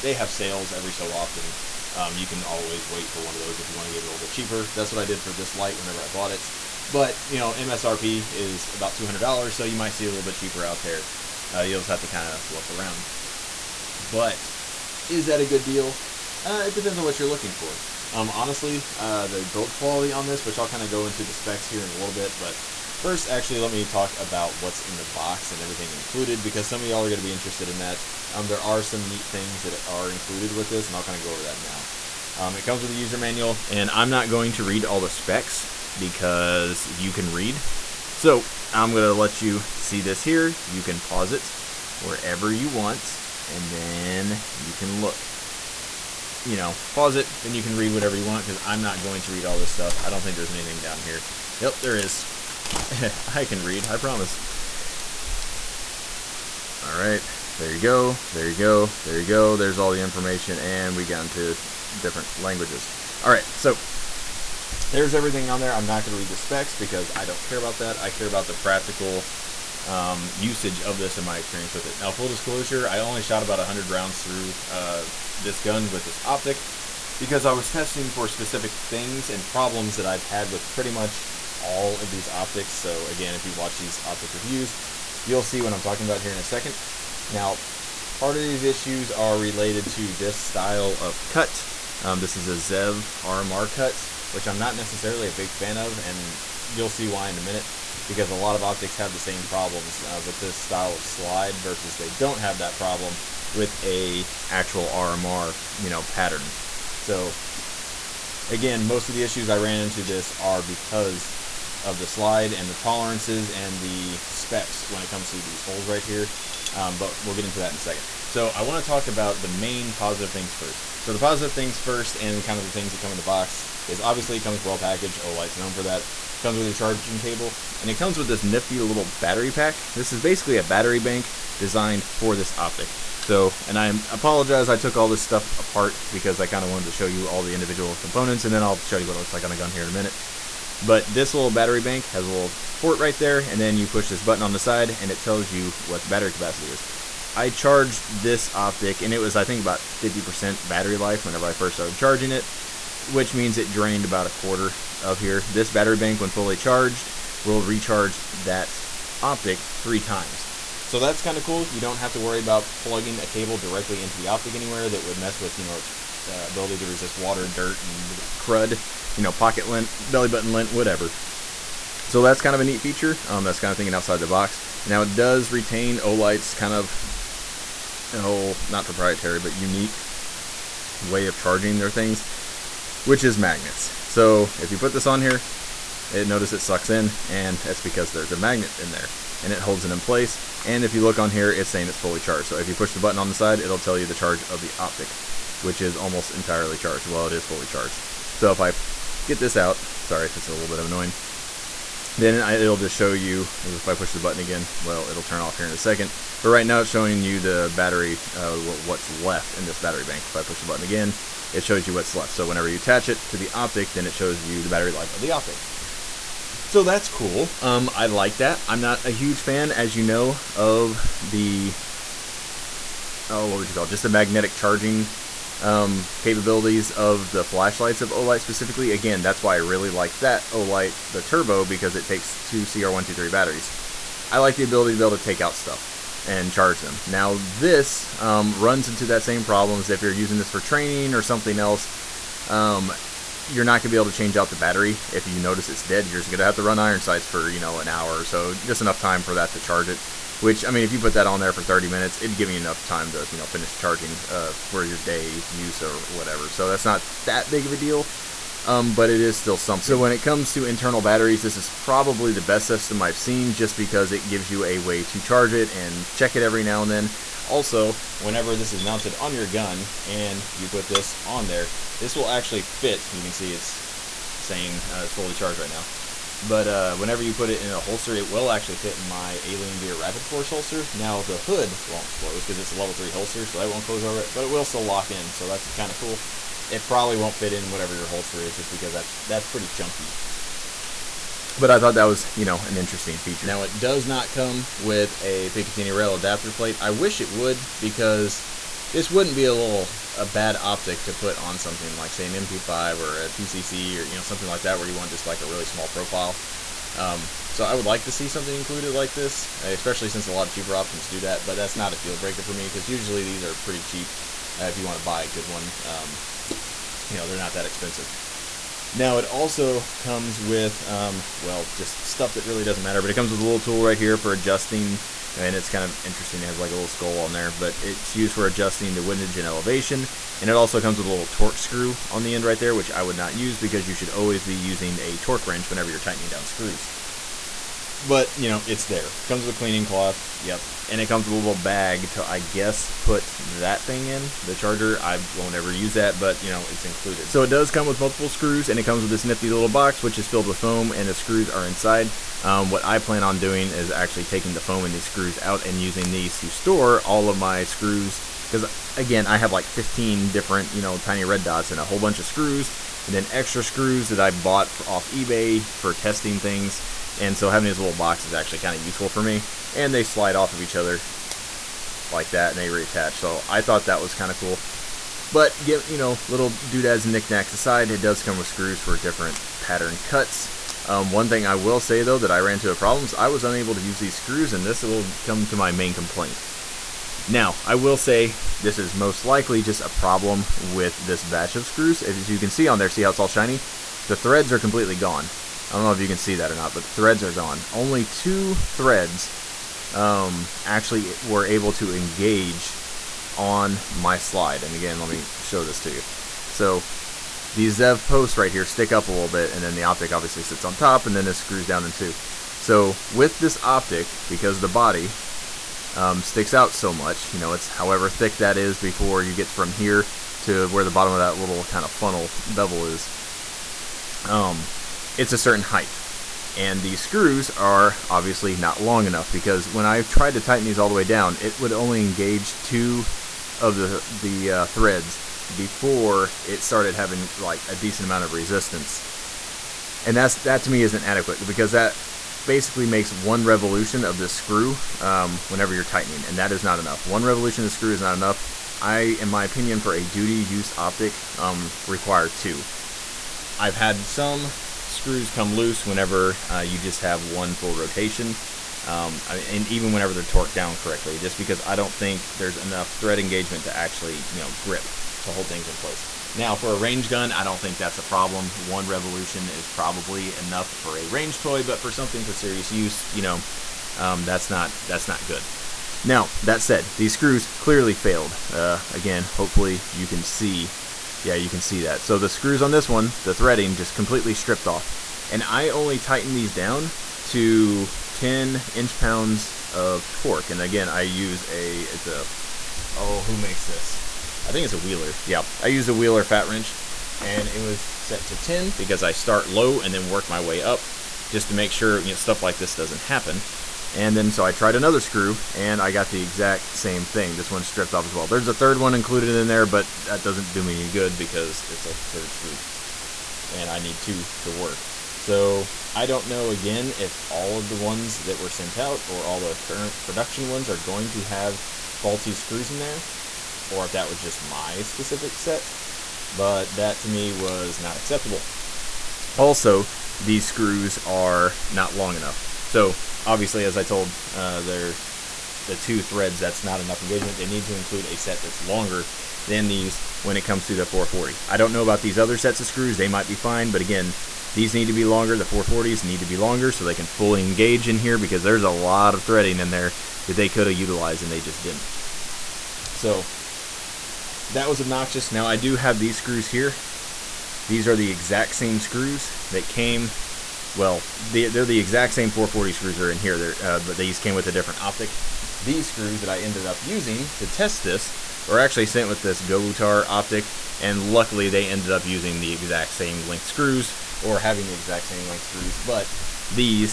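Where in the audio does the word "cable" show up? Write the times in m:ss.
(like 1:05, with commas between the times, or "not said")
2:07, 2:43.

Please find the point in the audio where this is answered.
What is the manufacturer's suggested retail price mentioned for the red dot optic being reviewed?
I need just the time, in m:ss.
0:08.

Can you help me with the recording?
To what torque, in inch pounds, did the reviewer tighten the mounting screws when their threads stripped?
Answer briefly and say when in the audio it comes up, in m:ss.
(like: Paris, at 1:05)
10, at 8:08.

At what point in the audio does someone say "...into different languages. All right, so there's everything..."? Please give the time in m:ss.
1:01.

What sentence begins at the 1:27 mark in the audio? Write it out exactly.
Now, part of these issues are related to this style of cut.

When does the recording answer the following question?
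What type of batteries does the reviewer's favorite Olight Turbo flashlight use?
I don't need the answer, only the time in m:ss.
3:52.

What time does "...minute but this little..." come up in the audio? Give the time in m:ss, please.
2:19.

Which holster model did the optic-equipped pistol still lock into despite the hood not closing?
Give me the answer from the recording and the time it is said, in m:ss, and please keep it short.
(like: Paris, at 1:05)
Alien Gear Rapid Force, at 4:39.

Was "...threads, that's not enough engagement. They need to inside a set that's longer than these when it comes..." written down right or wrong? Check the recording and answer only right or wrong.
wrong.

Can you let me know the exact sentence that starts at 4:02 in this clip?
Um, you're not going to be able to change out the battery.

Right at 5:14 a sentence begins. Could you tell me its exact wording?
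Uh, if you want to buy a good one, um, you know they're not that expensive.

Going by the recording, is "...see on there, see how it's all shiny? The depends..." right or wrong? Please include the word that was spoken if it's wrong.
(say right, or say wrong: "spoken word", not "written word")
wrong: "threads", not "depends".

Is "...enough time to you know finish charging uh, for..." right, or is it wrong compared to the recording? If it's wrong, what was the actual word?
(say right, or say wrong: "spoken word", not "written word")
right.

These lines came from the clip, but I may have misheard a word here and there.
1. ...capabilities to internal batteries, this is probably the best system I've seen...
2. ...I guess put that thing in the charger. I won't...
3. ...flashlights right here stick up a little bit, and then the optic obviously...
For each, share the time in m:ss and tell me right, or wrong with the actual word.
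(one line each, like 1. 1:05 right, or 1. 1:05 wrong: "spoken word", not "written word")
1. 4:20 wrong: "comes", not "capabilities"
2. 5:42 right
3. 6:48 wrong: "posts", not "flashlights".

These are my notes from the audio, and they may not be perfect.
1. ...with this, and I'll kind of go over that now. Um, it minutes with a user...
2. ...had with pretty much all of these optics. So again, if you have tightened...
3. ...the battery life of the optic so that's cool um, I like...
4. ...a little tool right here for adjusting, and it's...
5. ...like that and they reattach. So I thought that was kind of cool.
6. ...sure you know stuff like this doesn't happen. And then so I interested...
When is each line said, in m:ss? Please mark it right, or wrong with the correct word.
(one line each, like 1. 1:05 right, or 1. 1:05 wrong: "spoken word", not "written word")
1. 0:30 wrong: "comes", not "minutes"
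2. 1:20 wrong: "watched", not "tightened"
3. 3:34 right
4. 5:23 right
5. 6:12 right
6. 8:21 wrong: "tried", not "interested".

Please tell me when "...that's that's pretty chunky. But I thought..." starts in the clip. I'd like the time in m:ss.
4:48.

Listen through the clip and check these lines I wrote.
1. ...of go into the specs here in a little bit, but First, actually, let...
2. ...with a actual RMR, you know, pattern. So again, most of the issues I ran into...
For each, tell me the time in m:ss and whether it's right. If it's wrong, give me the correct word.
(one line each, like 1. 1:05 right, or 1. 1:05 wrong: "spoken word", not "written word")
1. 0:20 right
2. 1:43 right.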